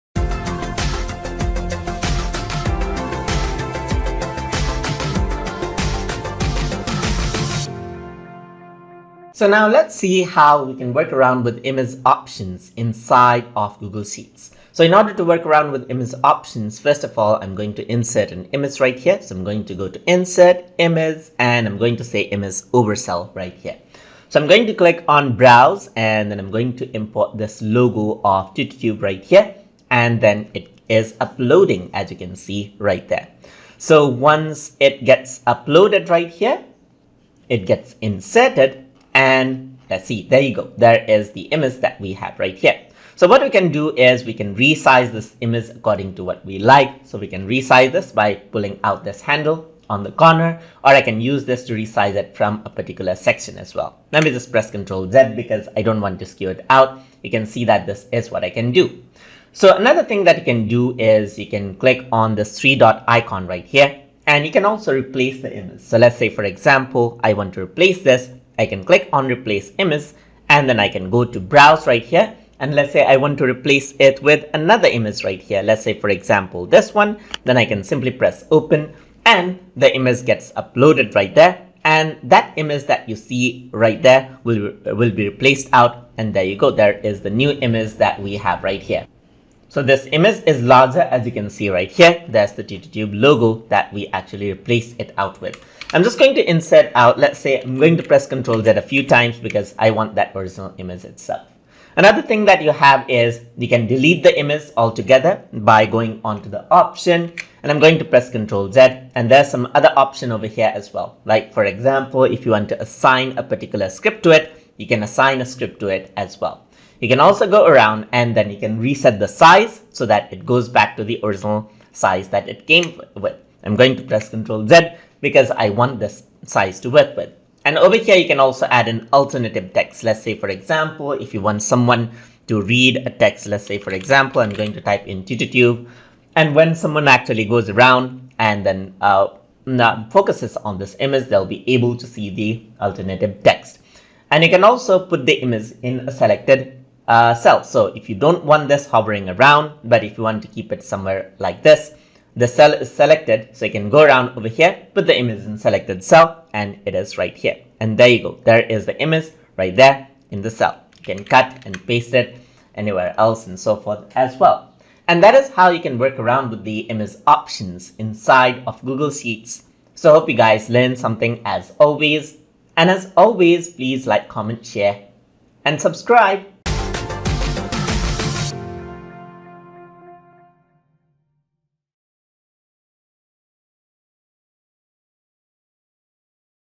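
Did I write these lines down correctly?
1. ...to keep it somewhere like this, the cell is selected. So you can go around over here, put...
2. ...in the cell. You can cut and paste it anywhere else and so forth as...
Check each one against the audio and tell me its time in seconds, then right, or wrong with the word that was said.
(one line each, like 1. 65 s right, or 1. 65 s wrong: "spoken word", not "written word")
1. 150 s right
2. 160 s right.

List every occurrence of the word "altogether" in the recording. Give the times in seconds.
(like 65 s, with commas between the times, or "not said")
104 s.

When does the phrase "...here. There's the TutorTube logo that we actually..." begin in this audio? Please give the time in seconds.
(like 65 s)
91 s.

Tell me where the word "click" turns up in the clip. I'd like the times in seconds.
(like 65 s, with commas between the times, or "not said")
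24 s, 61 s, 68 s.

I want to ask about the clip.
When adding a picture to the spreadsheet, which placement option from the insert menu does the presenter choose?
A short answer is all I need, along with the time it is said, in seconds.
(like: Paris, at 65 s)
Image over cell, at 22 s.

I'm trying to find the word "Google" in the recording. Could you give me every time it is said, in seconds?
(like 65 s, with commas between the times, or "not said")
13 s, 168 s.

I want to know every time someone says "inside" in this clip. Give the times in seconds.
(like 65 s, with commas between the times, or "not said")
12 s, 167 s.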